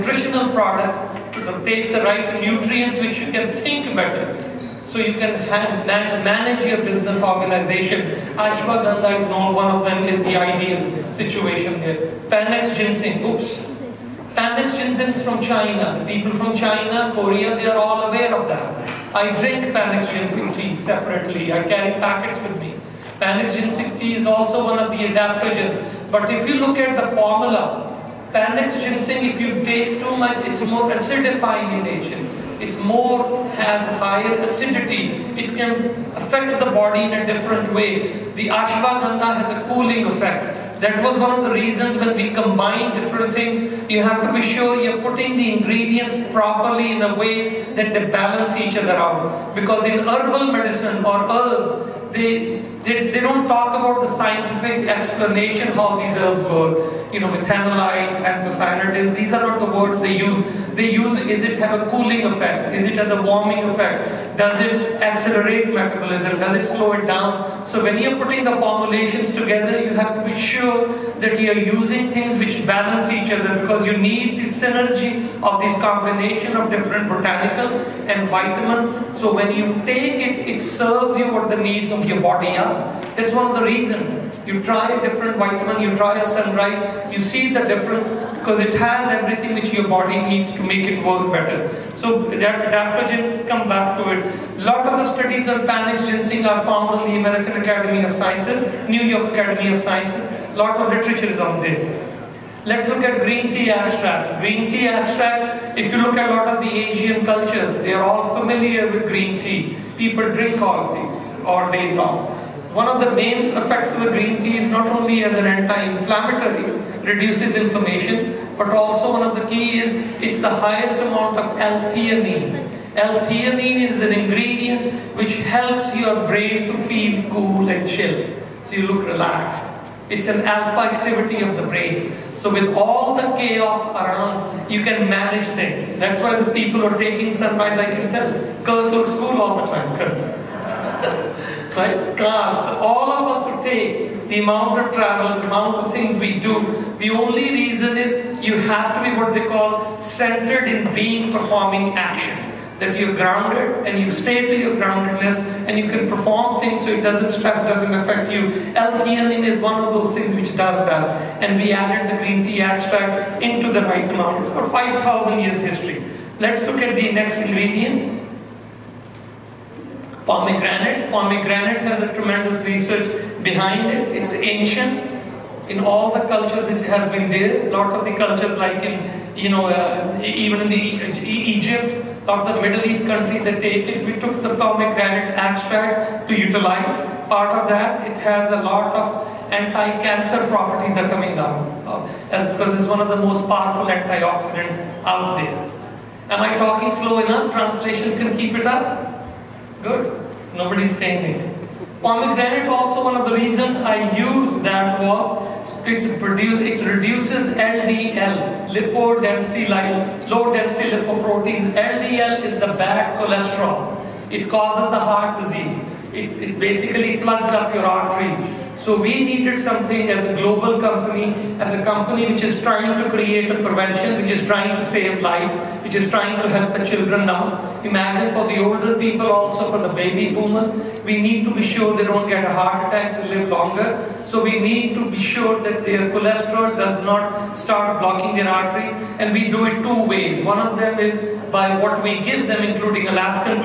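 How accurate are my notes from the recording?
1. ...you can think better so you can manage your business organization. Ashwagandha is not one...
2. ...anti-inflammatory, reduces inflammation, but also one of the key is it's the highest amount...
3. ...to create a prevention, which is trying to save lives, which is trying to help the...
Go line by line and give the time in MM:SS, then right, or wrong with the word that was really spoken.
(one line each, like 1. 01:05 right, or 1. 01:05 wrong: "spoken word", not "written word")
1. 00:03 right
2. 01:55 right
3. 03:43 right.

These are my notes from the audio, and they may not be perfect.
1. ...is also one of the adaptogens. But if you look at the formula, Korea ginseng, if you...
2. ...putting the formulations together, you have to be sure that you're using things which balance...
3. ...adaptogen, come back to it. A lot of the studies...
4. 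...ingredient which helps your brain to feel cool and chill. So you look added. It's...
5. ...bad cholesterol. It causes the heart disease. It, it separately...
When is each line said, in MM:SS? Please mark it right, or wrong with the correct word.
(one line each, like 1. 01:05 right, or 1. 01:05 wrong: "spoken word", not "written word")
1. 00:24 wrong: "Panax", not "Korea"
2. 01:08 right
3. 01:32 right
4. 02:04 wrong: "relaxed", not "added"
5. 03:32 wrong: "basically", not "separately".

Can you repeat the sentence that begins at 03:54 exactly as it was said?
So we need to be sure that their cholesterol does not start blocking their arteries.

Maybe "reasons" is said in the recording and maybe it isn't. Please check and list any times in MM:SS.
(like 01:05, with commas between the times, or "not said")
00:41, 01:23, 02:27, 03:23.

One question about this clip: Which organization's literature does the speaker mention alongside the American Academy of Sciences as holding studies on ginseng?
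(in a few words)
New York Academy of Sciences.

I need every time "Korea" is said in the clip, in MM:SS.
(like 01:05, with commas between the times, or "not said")
00:17.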